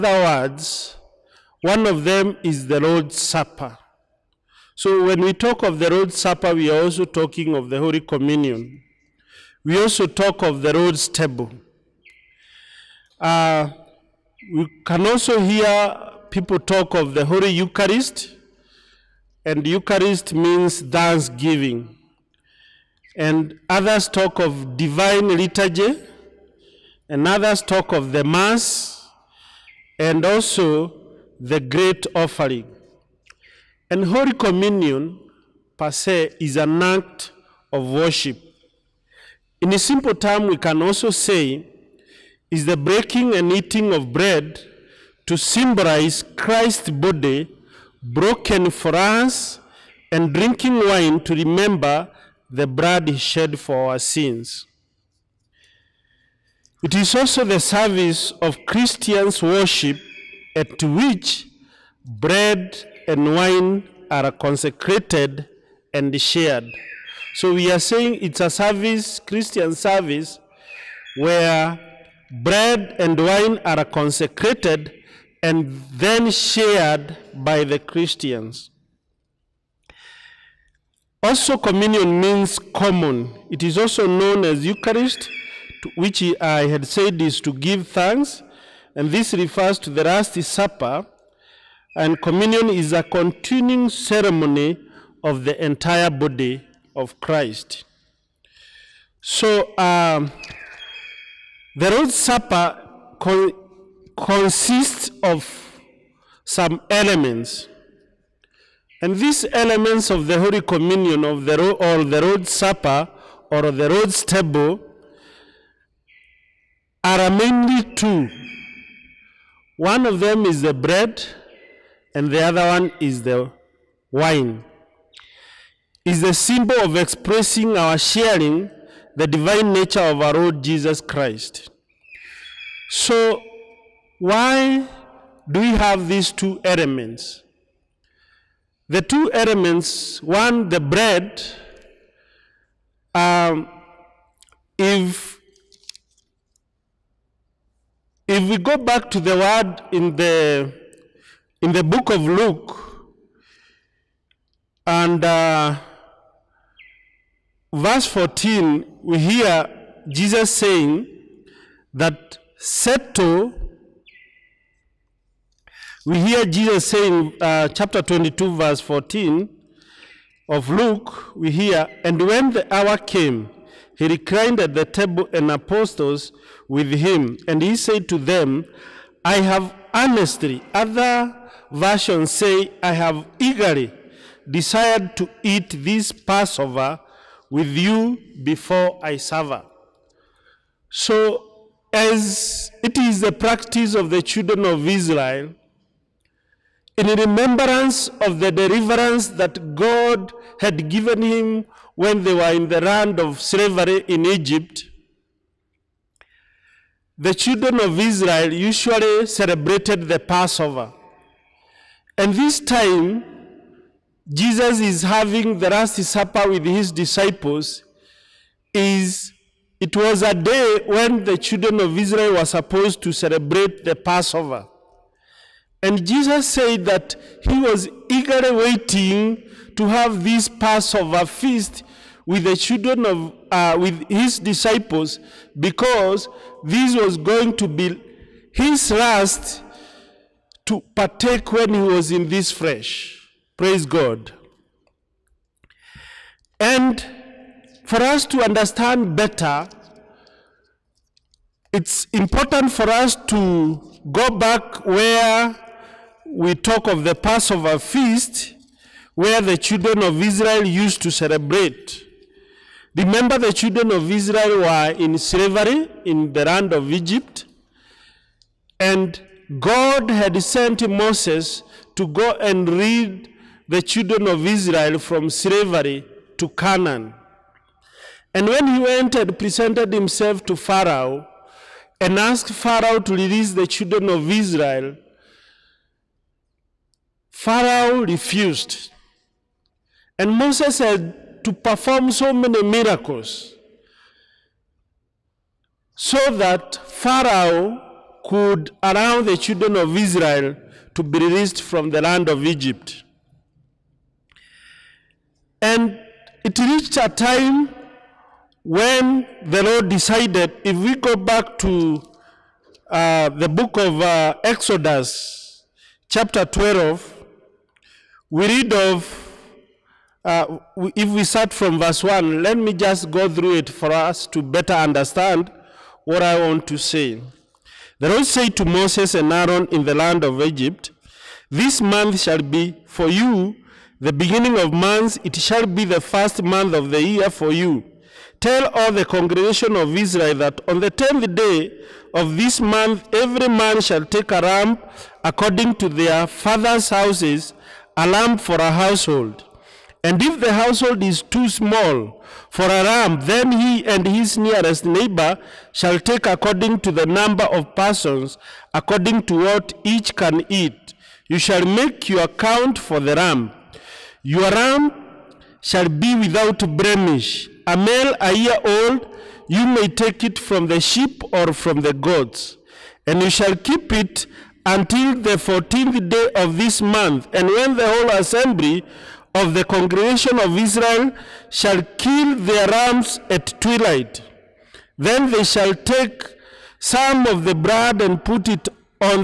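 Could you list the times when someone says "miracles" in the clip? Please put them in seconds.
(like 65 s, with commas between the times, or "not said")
292 s.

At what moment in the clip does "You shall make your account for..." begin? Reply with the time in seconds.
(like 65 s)
361 s.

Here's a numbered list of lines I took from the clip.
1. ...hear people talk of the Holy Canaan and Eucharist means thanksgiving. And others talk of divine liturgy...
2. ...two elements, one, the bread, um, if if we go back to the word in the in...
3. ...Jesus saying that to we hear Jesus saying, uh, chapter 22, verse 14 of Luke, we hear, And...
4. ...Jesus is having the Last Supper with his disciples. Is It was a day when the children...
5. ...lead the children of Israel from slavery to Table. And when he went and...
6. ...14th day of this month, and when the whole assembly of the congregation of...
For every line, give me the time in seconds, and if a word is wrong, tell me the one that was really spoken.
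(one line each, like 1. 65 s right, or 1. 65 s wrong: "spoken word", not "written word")
1. 15 s wrong: "Eucharist", not "Canaan"
2. 139 s right
3. 160 s right
4. 214 s right
5. 272 s wrong: "Canaan", not "Table"
6. 375 s right.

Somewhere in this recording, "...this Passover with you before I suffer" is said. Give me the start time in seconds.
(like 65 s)
185 s.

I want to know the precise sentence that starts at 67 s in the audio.
So we are saying it's a service, Christian service, where bread and wine are consecrated and then shared by the Christians.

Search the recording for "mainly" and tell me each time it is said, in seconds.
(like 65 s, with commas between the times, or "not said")
117 s.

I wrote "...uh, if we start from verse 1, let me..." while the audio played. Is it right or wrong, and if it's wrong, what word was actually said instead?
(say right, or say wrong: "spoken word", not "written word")
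right.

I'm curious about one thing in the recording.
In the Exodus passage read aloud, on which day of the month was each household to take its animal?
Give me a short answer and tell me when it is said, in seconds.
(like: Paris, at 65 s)
10th, at 340 s.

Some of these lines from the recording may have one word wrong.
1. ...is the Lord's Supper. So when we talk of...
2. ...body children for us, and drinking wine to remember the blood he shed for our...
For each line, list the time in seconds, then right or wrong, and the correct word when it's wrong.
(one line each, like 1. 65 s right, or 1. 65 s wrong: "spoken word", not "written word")
1. 2 s right
2. 46 s wrong: "broken", not "children".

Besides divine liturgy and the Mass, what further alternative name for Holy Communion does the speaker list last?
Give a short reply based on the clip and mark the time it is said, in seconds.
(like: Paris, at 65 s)
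the great offering, at 31 s.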